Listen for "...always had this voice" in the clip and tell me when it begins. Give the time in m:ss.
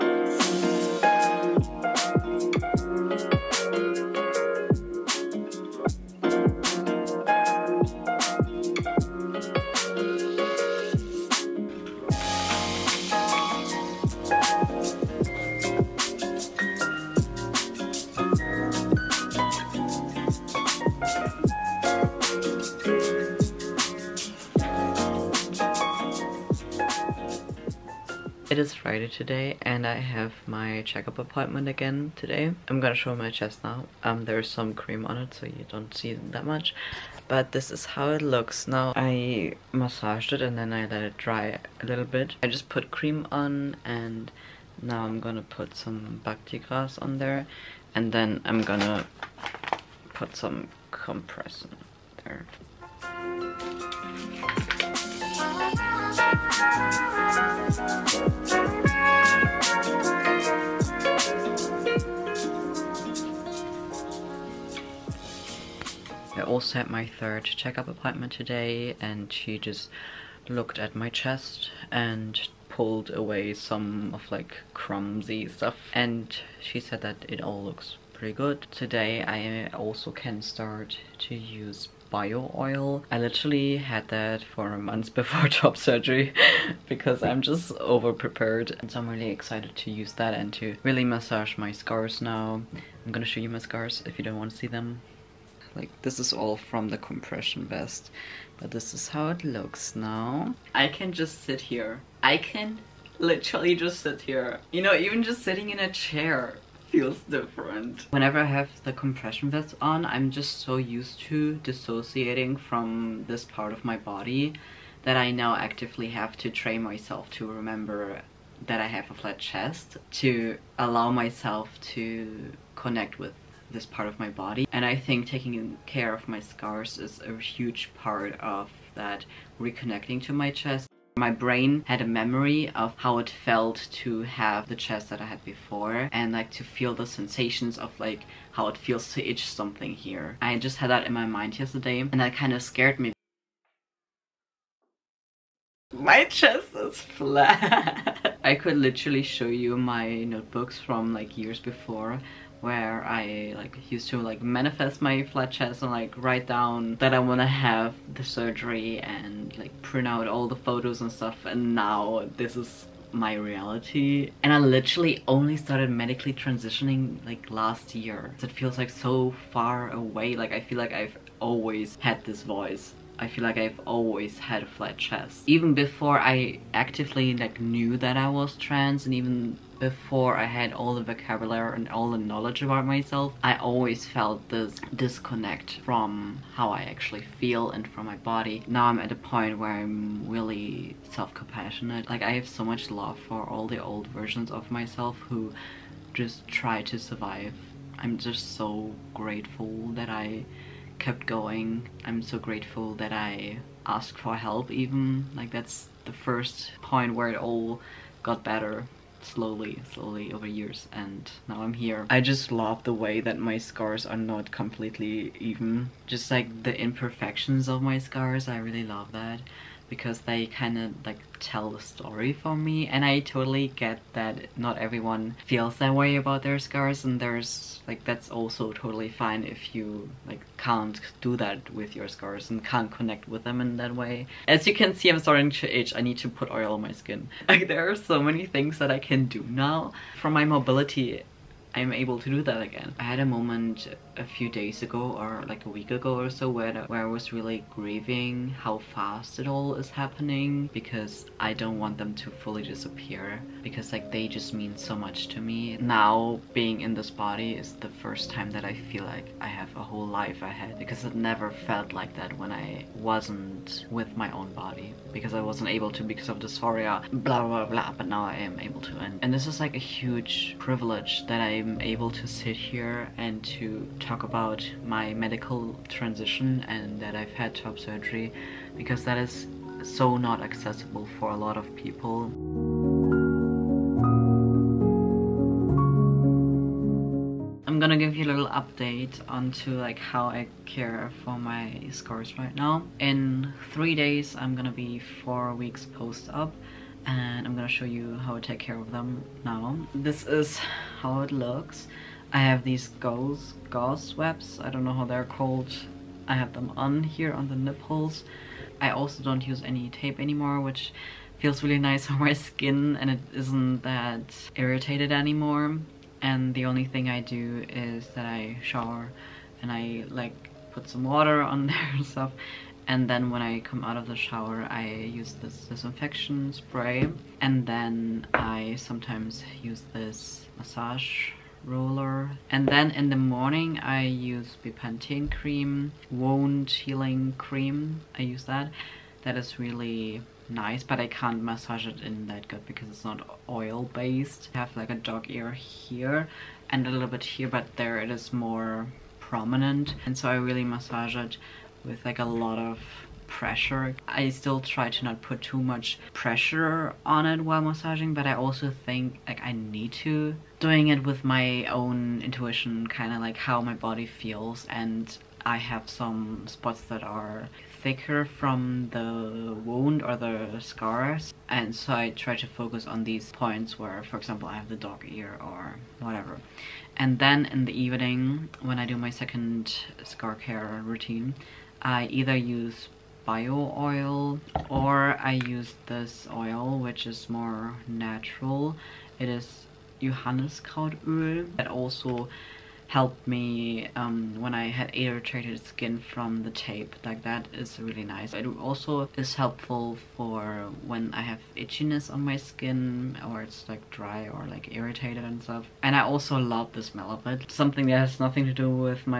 2:51.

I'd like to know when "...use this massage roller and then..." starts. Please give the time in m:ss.
5:29.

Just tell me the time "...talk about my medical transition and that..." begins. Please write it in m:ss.
4:34.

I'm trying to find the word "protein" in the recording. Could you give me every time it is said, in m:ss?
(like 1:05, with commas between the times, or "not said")
not said.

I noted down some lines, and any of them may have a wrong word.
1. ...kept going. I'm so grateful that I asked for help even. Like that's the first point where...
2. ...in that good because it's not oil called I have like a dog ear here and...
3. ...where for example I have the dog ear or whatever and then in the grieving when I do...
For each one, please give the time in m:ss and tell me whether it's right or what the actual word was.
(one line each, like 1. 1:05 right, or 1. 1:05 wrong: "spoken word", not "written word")
1. 3:20 right
2. 5:42 wrong: "based", not "called"
3. 6:13 wrong: "evening", not "grieving".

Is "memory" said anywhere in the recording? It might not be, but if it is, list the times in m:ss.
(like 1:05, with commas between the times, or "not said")
2:12.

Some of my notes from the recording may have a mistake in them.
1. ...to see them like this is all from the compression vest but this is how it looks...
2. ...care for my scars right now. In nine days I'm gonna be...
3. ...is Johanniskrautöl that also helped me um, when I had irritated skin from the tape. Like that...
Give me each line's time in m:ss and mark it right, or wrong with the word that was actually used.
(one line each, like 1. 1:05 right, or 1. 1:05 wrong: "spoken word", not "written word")
1. 1:34 right
2. 4:50 wrong: "three", not "nine"
3. 6:29 right.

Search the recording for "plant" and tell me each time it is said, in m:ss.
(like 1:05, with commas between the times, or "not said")
not said.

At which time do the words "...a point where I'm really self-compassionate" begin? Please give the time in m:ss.
3:09.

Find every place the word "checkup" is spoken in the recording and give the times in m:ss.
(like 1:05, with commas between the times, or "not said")
0:30, 1:07.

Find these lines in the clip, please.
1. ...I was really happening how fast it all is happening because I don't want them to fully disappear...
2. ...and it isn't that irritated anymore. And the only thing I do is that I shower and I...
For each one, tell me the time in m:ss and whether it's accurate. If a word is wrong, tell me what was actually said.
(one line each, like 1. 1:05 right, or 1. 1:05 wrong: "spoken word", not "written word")
1. 4:07 wrong: "grieving", not "happening"
2. 5:13 right.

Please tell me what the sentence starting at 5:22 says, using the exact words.
And then when I come out of the shower, I use this disinfection spray.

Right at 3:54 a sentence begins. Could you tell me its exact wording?
As you can see I'm starting to itch, I need to put oil on my skin.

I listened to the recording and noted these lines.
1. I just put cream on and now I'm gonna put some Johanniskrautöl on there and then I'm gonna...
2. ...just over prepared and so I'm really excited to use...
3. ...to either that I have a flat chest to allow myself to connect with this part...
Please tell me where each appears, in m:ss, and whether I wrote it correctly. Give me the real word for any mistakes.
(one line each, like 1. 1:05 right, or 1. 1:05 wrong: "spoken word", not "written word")
1. 0:42 wrong: "Bactigras", not "Johanniskrautöl"
2. 1:27 right
3. 1:57 wrong: "remember", not "either".